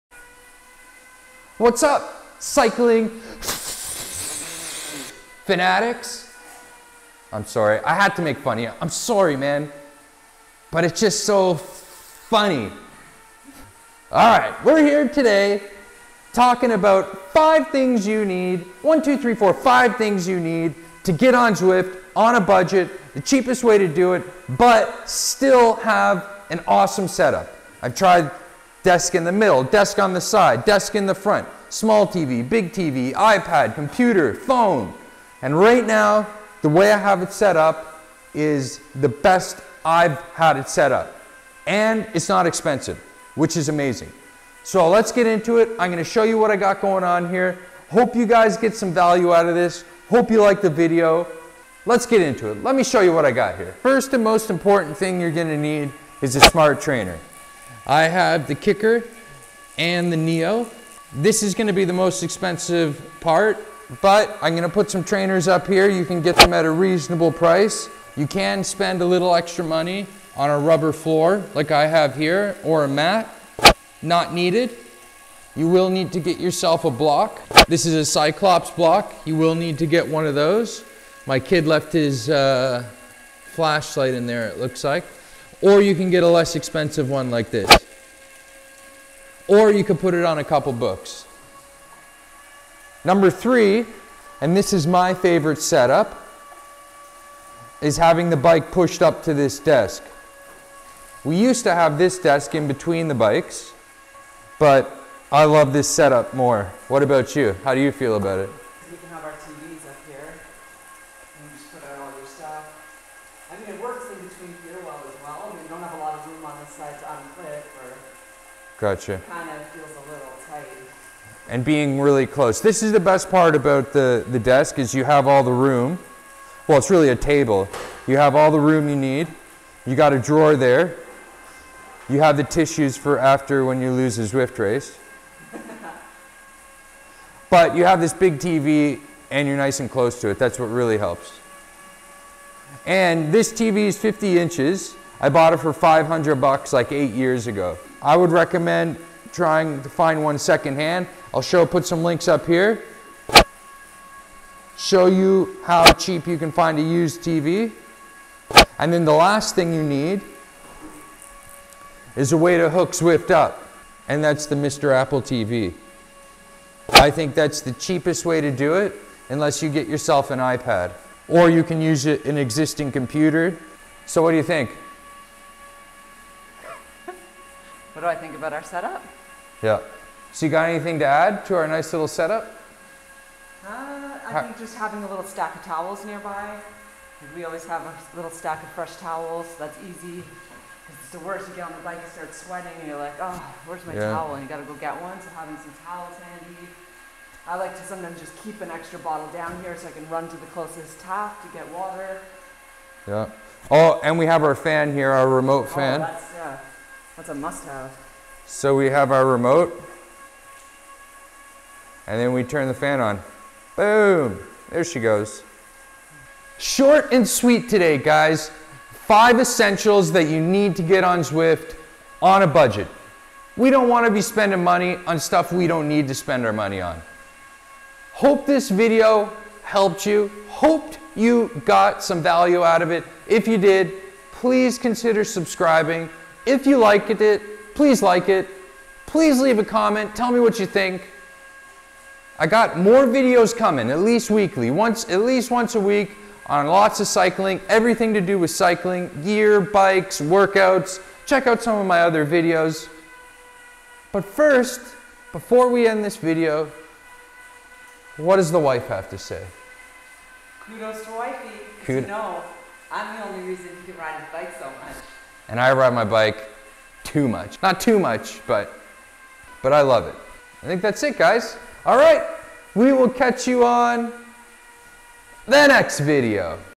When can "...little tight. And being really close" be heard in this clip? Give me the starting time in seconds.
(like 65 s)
120 s.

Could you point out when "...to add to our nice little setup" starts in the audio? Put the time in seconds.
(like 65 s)
180 s.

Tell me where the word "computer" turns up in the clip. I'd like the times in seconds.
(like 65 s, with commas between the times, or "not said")
33 s, 172 s.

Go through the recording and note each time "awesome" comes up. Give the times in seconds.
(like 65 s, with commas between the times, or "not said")
26 s.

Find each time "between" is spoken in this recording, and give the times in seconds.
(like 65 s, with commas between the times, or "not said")
102 s, 114 s.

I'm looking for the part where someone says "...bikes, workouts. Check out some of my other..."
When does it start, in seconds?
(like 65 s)
249 s.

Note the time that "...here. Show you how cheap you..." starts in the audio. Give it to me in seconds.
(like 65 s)
152 s.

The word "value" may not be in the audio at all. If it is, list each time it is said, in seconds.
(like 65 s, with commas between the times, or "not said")
48 s, 232 s.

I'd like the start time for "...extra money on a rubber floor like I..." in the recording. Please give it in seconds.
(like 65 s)
69 s.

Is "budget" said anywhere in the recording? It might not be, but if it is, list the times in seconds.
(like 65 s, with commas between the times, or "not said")
22 s, 222 s.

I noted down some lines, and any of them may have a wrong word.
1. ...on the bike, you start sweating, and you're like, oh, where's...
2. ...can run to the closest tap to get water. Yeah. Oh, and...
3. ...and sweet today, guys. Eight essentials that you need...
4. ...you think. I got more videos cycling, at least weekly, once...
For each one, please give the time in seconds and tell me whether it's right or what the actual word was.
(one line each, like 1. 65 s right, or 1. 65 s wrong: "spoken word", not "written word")
1. 191 s right
2. 199 s right
3. 217 s wrong: "Five", not "Eight"
4. 240 s wrong: "coming", not "cycling".